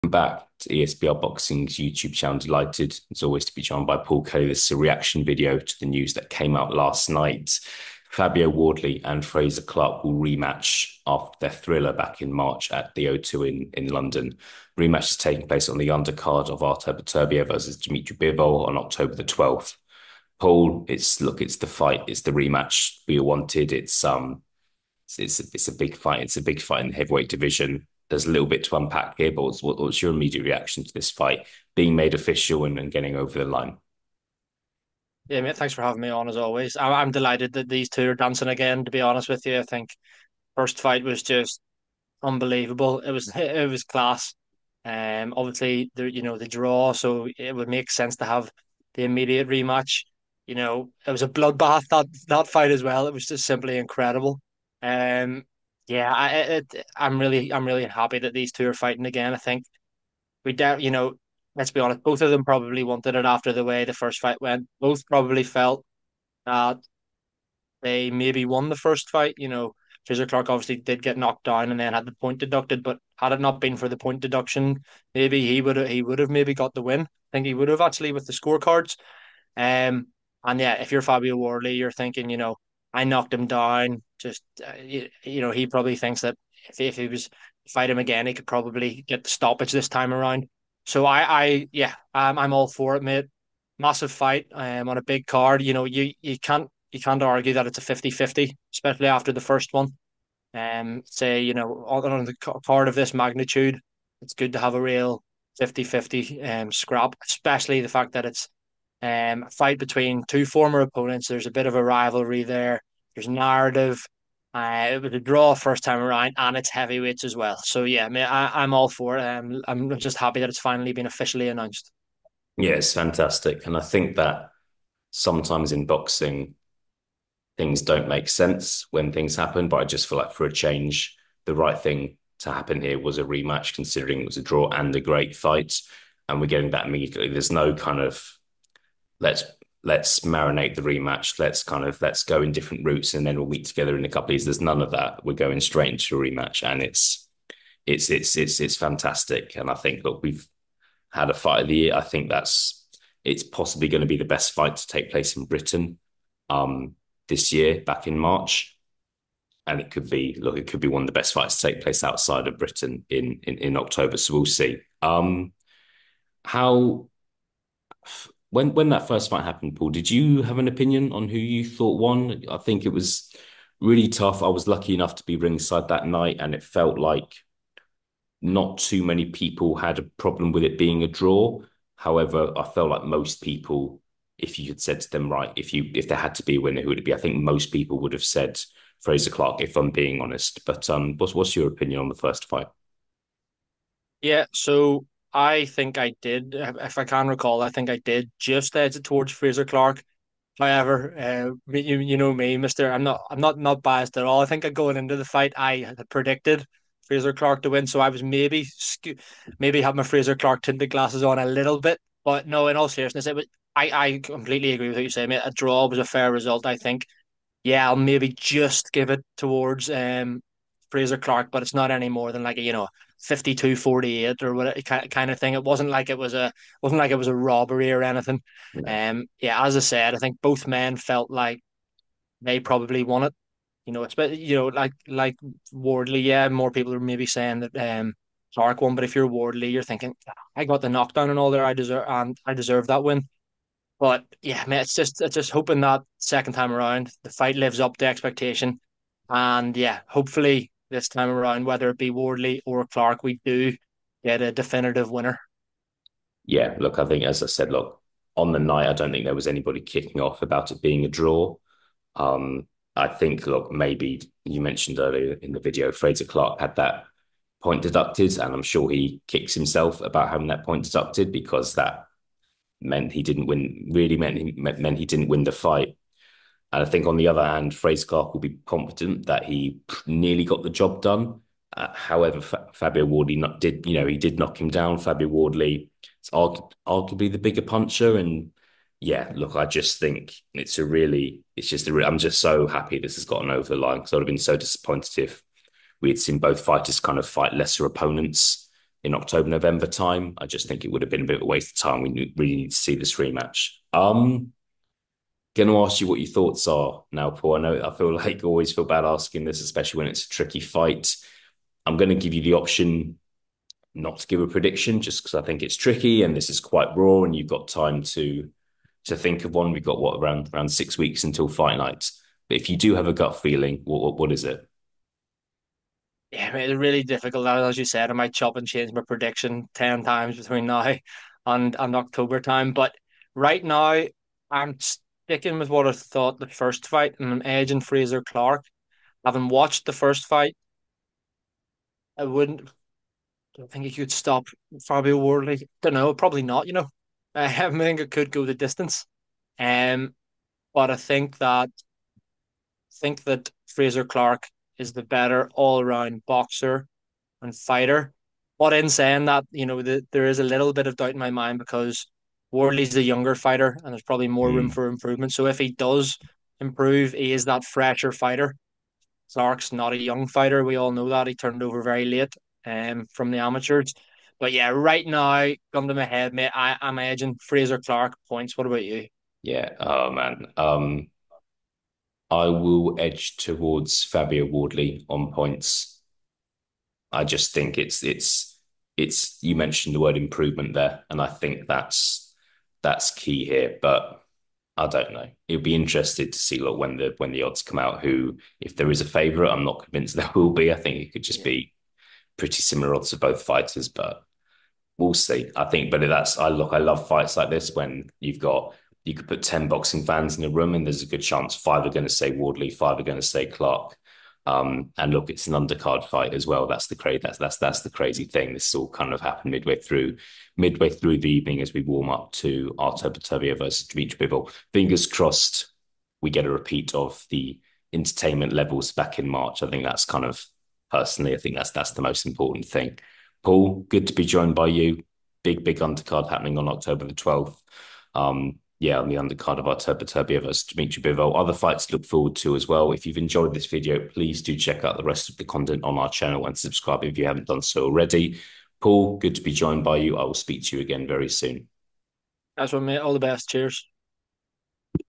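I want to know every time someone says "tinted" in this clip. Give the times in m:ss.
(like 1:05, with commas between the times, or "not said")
3:30.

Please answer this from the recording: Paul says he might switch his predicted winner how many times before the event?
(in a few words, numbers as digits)
10.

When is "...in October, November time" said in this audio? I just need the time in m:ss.
4:59.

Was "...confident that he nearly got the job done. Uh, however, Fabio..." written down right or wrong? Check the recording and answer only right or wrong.
right.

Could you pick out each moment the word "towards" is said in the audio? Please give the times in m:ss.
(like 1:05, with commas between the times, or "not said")
3:19, 3:39, 6:23.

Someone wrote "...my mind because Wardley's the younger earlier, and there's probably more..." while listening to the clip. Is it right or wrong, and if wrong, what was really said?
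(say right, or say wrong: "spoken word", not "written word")
wrong: "fighter", not "earlier".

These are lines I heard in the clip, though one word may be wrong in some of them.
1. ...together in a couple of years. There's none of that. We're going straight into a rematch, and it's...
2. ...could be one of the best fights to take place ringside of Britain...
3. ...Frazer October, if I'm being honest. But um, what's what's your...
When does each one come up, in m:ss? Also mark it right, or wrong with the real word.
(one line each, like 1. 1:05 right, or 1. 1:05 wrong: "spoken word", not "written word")
1. 2:23 right
2. 2:40 wrong: "outside", not "ringside"
3. 3:09 wrong: "Clarke", not "October".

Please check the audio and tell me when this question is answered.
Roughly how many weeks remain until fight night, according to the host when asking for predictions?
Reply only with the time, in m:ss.
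5:20.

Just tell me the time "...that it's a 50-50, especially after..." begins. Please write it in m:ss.
1:37.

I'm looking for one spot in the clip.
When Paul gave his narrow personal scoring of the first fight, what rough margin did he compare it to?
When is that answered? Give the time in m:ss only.
3:43.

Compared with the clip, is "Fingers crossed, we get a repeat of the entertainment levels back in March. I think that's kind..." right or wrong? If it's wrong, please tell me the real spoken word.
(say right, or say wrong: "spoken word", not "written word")
right.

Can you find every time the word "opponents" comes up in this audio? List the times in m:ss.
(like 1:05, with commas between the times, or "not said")
1:50, 4:57.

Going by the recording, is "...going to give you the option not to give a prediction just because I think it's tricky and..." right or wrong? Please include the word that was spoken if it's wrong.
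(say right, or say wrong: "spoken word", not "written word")
right.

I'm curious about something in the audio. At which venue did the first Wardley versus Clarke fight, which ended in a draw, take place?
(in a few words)
The O2.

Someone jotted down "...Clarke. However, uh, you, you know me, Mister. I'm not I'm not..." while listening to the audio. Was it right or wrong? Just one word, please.
right.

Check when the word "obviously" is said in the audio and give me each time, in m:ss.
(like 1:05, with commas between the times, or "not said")
0:45, 1:10.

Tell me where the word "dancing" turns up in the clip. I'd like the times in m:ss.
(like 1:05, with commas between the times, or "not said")
0:38.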